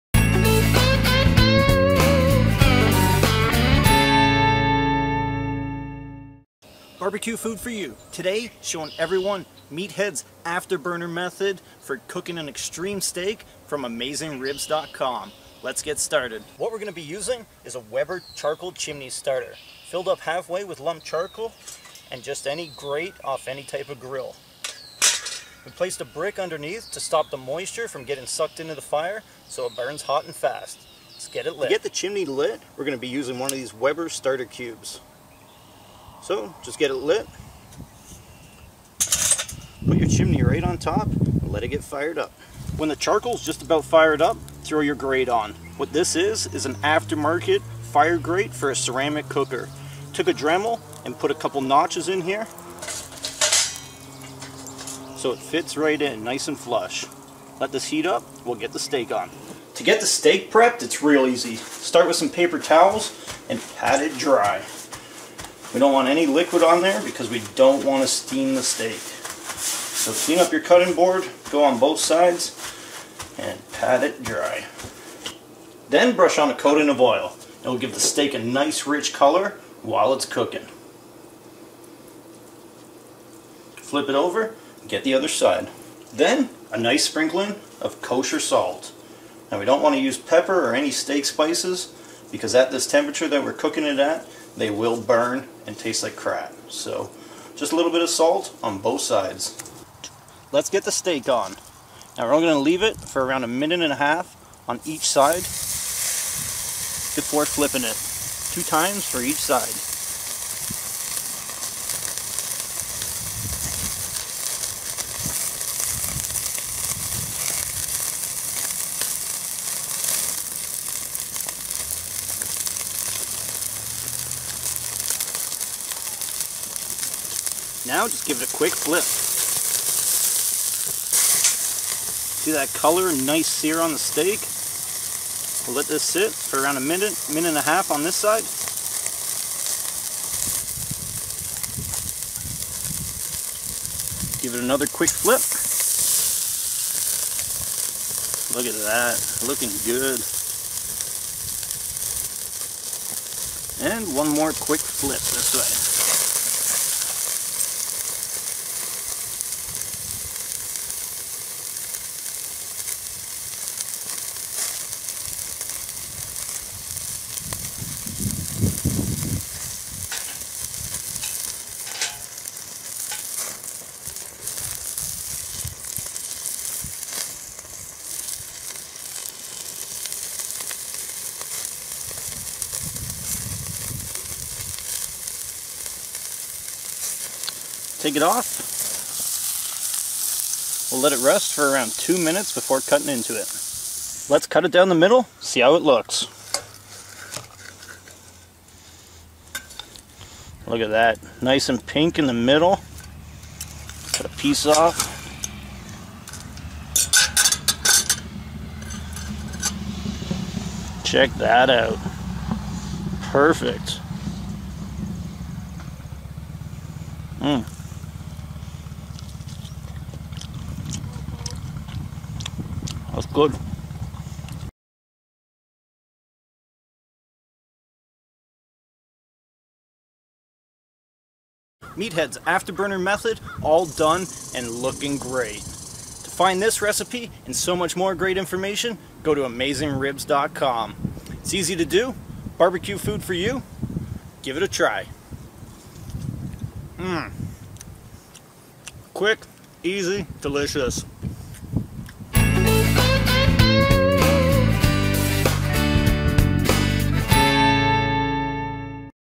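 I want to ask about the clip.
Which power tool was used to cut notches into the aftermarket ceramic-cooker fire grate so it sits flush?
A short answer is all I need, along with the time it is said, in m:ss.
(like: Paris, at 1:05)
Dremel, at 0:50.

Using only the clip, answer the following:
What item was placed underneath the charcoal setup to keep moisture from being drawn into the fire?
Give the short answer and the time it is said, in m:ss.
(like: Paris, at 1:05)
A brick, at 0:26.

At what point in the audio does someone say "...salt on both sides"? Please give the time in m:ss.
1:38.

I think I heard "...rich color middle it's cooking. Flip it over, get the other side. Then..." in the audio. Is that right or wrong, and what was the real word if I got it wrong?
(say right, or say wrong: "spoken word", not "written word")
wrong: "while", not "middle".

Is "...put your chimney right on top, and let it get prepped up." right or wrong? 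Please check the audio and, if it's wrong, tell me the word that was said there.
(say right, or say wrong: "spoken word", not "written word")
wrong: "fired", not "prepped".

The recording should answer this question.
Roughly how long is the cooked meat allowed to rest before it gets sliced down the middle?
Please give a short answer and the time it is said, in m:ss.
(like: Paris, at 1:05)
2 minutes, at 3:11.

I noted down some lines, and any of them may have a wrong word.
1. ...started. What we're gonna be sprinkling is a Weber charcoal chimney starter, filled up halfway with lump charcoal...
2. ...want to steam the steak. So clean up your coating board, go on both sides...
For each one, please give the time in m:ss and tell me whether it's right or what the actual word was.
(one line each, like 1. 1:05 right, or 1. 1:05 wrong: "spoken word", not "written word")
1. 0:15 wrong: "using", not "sprinkling"
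2. 1:07 wrong: "cutting", not "coating".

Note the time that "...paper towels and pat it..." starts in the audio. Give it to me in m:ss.
1:02.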